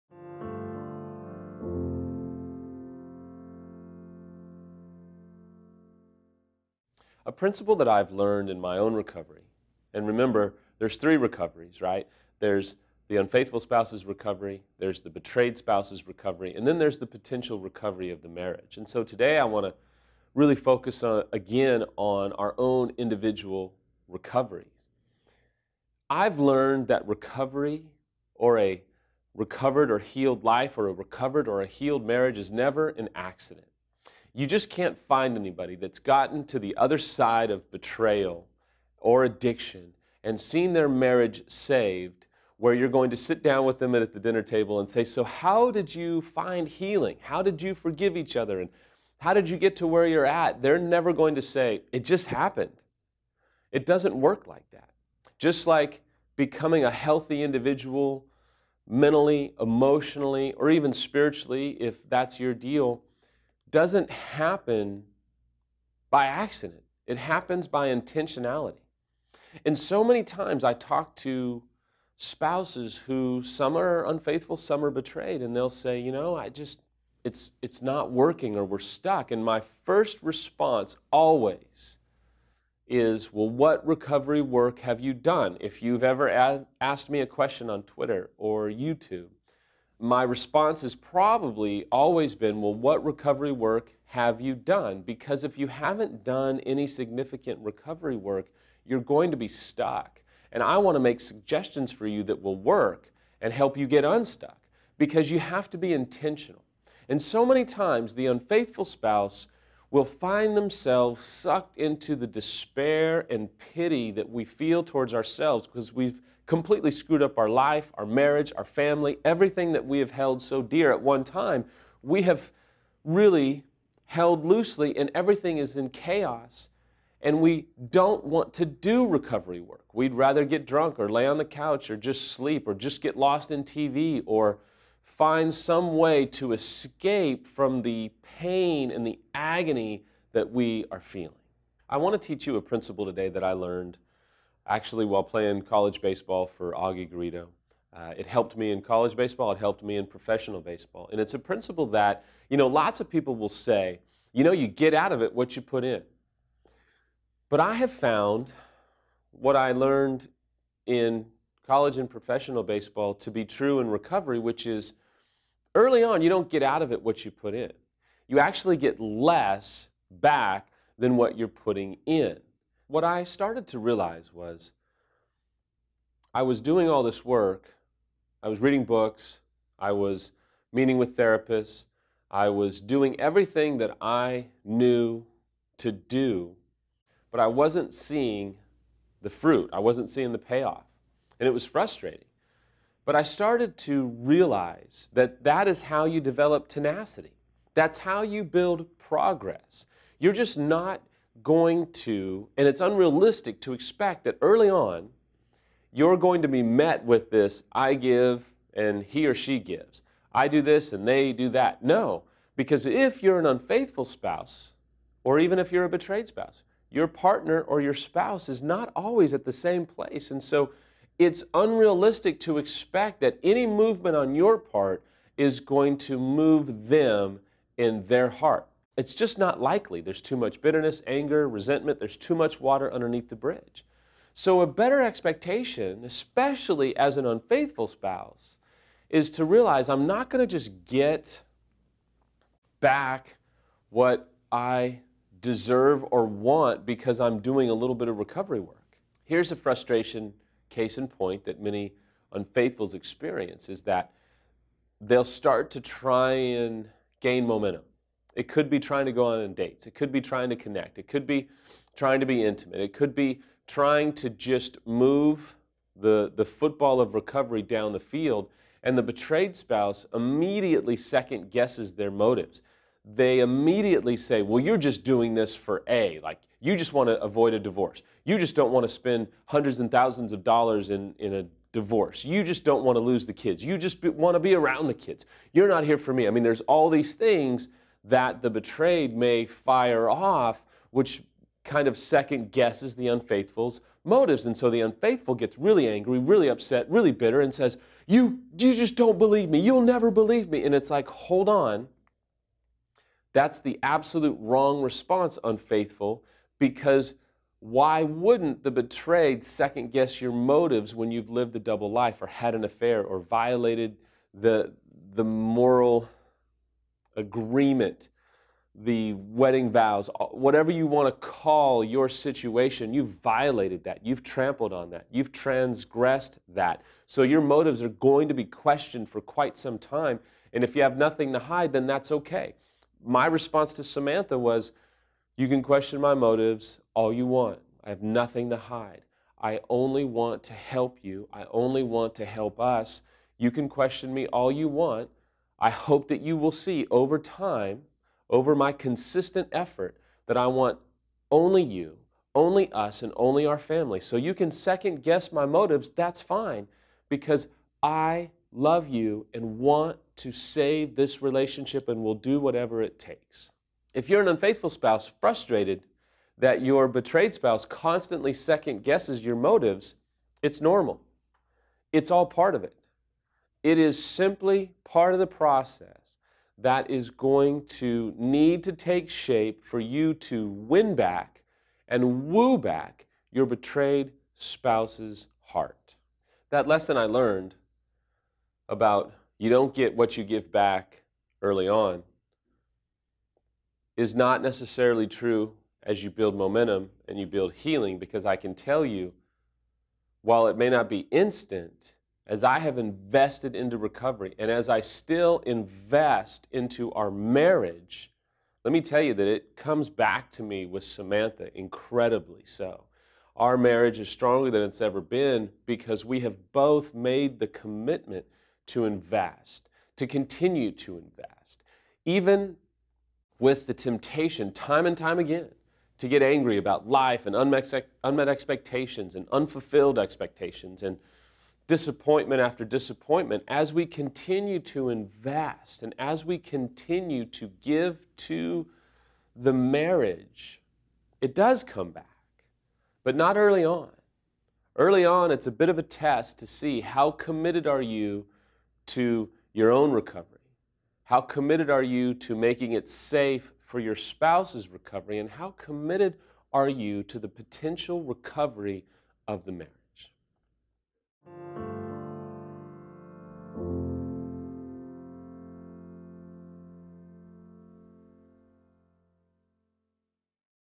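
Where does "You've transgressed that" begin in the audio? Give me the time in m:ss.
5:25.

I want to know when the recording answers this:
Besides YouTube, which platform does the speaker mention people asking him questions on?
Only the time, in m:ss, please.
1:27.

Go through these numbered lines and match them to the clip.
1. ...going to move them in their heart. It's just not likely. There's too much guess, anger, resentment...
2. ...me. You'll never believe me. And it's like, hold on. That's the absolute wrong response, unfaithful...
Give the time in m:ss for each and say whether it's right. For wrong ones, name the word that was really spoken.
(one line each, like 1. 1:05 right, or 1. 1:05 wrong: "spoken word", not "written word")
1. 3:45 wrong: "bitterness", not "guess"
2. 4:59 right.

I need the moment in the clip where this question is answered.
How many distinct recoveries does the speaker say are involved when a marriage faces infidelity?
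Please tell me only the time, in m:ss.
0:10.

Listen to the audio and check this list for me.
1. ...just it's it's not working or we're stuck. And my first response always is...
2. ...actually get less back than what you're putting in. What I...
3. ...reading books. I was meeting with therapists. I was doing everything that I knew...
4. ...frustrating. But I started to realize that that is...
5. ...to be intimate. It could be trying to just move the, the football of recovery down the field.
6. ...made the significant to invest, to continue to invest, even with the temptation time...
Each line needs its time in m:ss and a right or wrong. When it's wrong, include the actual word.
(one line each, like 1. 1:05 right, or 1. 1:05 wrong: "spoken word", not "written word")
1. 1:16 right
2. 2:48 right
3. 2:58 right
4. 3:11 right
5. 4:22 right
6. 6:56 wrong: "commitment", not "significant".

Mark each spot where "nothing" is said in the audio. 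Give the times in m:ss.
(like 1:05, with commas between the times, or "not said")
5:30, 5:38.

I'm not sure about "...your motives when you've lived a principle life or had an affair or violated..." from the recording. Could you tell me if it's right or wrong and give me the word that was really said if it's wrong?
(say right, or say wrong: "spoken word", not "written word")
wrong: "double", not "principle".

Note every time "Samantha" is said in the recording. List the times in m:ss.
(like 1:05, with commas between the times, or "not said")
5:33, 6:50.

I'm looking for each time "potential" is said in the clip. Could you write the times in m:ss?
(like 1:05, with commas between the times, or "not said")
0:17, 7:37.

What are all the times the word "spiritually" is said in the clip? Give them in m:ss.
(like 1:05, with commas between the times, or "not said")
1:00.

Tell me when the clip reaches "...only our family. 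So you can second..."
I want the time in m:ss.
5:53.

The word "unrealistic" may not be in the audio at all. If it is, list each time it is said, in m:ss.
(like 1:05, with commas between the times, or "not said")
3:22, 3:41.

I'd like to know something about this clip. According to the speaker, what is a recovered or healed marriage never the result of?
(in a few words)
an accident.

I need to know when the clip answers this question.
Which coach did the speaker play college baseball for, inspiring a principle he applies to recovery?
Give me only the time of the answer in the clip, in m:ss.
2:26.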